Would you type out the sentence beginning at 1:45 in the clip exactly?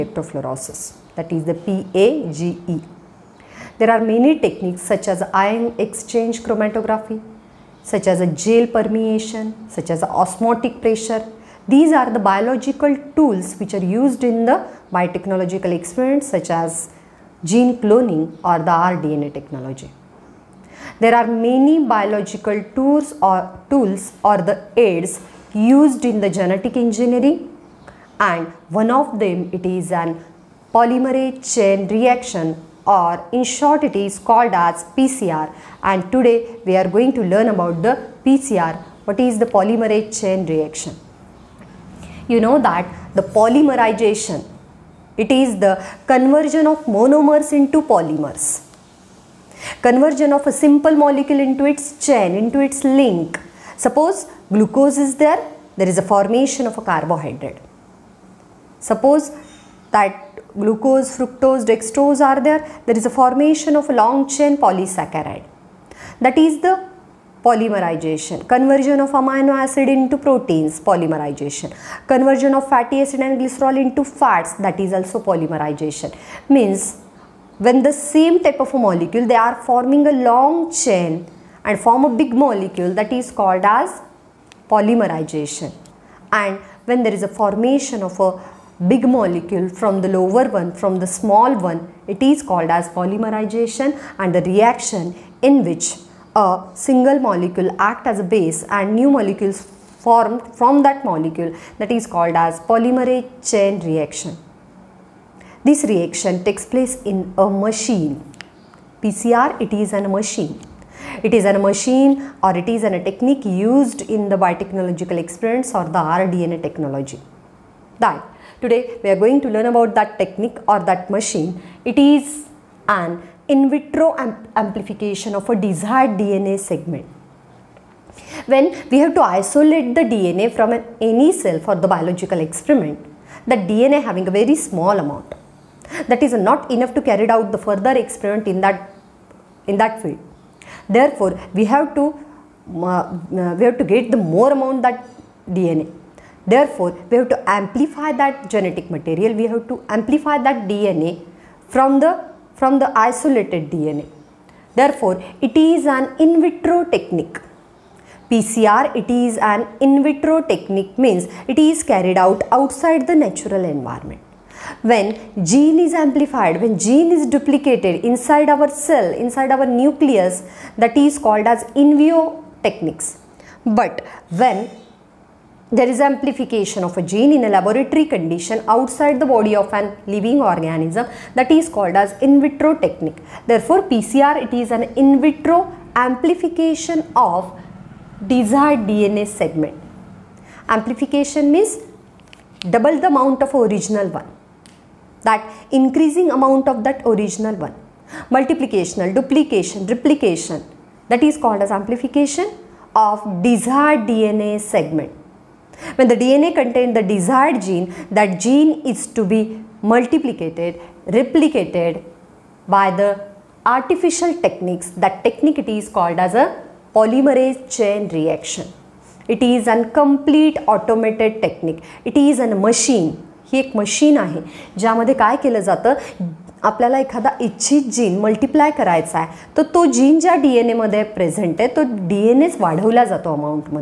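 This reaction takes place in a machine.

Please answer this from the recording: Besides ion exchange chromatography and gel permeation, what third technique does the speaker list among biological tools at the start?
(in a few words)
osmotic pressure.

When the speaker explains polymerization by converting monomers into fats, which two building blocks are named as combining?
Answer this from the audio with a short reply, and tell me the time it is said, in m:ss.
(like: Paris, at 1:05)
fatty acid and glycerol, at 1:12.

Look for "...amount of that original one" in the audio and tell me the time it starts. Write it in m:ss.
3:16.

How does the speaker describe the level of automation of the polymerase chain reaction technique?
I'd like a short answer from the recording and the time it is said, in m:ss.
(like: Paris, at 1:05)
complete automated, at 3:39.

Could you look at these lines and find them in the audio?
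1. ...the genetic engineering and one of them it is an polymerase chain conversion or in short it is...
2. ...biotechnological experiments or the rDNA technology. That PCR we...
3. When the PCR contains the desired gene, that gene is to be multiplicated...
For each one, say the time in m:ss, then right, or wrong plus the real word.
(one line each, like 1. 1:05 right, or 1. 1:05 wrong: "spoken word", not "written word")
1. 0:26 wrong: "reaction", not "conversion"
2. 1:54 wrong: "Today", not "PCR"
3. 3:25 wrong: "DNA", not "PCR".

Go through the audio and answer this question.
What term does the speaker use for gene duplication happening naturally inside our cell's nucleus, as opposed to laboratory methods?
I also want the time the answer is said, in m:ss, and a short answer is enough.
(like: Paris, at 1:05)
in vivo techniques, at 2:51.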